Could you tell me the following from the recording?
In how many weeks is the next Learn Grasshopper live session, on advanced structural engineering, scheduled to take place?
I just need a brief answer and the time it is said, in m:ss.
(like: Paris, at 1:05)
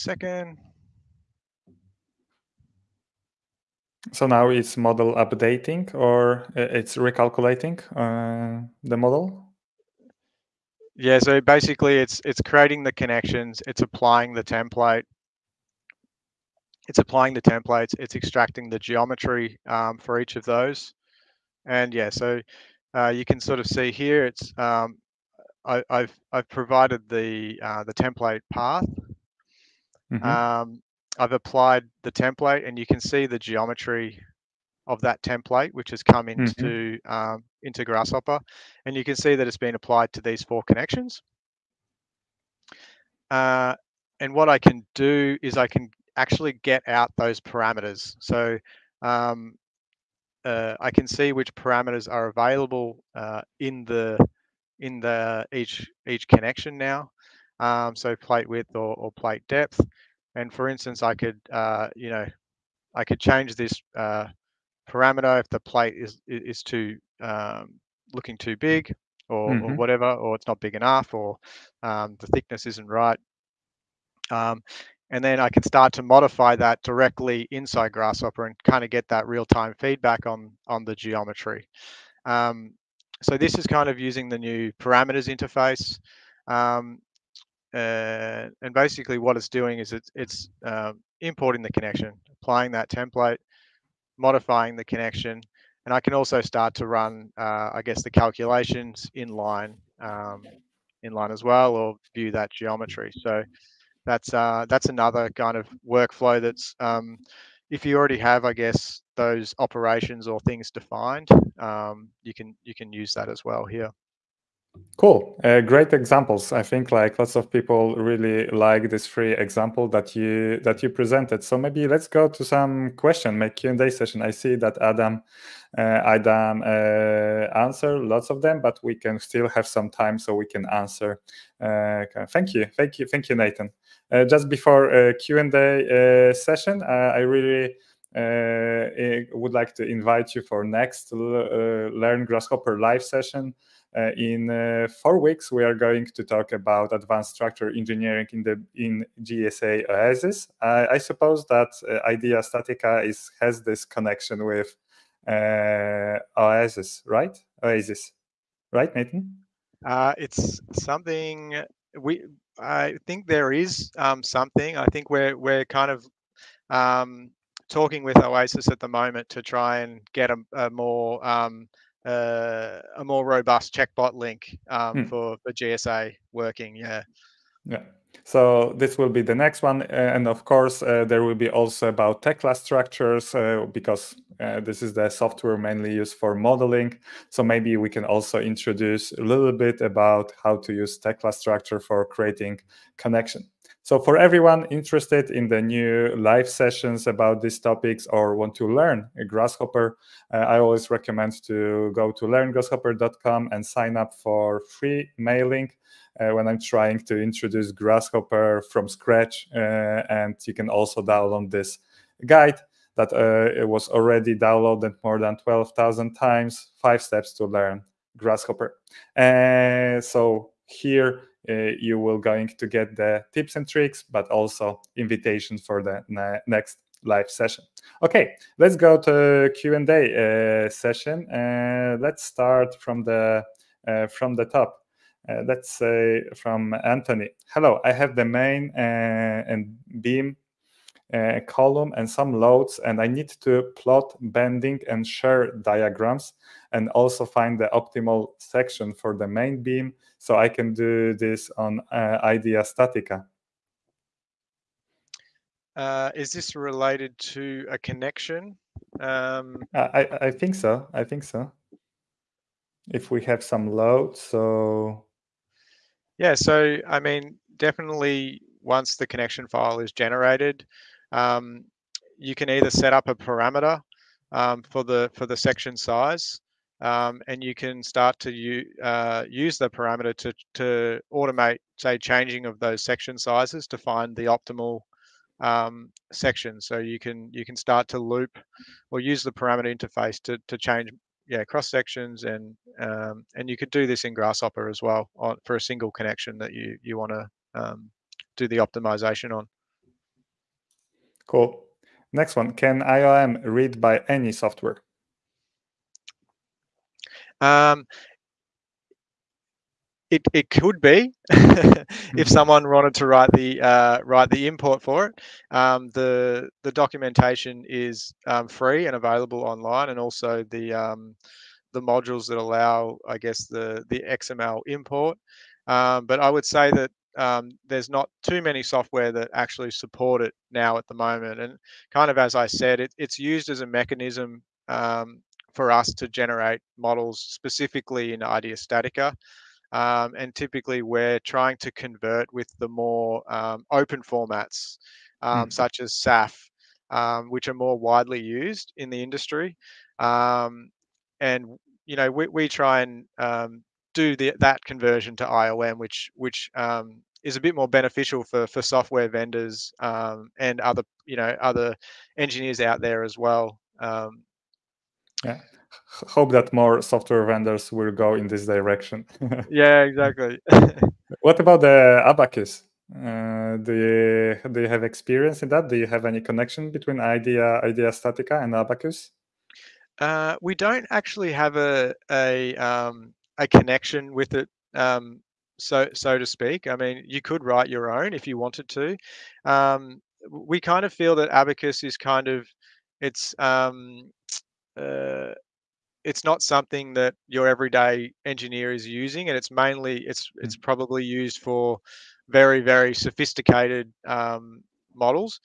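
4, at 2:24.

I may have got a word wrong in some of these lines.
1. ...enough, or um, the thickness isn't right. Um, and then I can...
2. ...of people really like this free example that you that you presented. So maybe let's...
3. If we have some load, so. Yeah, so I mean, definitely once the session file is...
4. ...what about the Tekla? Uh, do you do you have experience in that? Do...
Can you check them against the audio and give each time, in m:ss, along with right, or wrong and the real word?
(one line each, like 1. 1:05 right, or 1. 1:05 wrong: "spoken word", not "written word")
1. 1:10 right
2. 1:57 right
3. 4:22 wrong: "connection", not "session"
4. 6:11 wrong: "Abaqus", not "Tekla".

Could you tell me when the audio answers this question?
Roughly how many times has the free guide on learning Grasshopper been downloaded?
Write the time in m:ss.
3:35.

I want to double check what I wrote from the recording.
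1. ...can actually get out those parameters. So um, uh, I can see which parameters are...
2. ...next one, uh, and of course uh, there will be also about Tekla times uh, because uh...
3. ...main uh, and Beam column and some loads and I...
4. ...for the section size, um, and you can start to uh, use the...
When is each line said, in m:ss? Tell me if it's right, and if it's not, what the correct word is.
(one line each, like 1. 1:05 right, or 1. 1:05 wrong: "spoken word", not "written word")
1. 0:45 right
2. 2:59 wrong: "structures", not "times"
3. 3:58 right
4. 4:35 right.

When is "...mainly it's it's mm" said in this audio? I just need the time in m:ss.
6:39.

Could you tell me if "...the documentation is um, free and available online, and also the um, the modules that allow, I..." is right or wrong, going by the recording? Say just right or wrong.
right.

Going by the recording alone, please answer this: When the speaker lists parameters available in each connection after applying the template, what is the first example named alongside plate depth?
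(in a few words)
plate width.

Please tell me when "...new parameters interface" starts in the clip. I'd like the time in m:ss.
1:24.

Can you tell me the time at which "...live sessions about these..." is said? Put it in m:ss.
3:16.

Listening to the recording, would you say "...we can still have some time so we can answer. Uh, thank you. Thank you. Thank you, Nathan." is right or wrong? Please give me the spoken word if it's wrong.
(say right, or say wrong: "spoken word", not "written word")
right.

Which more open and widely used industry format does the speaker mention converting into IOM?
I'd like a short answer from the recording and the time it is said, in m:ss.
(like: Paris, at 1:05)
SAF, at 5:45.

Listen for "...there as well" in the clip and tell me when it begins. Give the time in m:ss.
6:02.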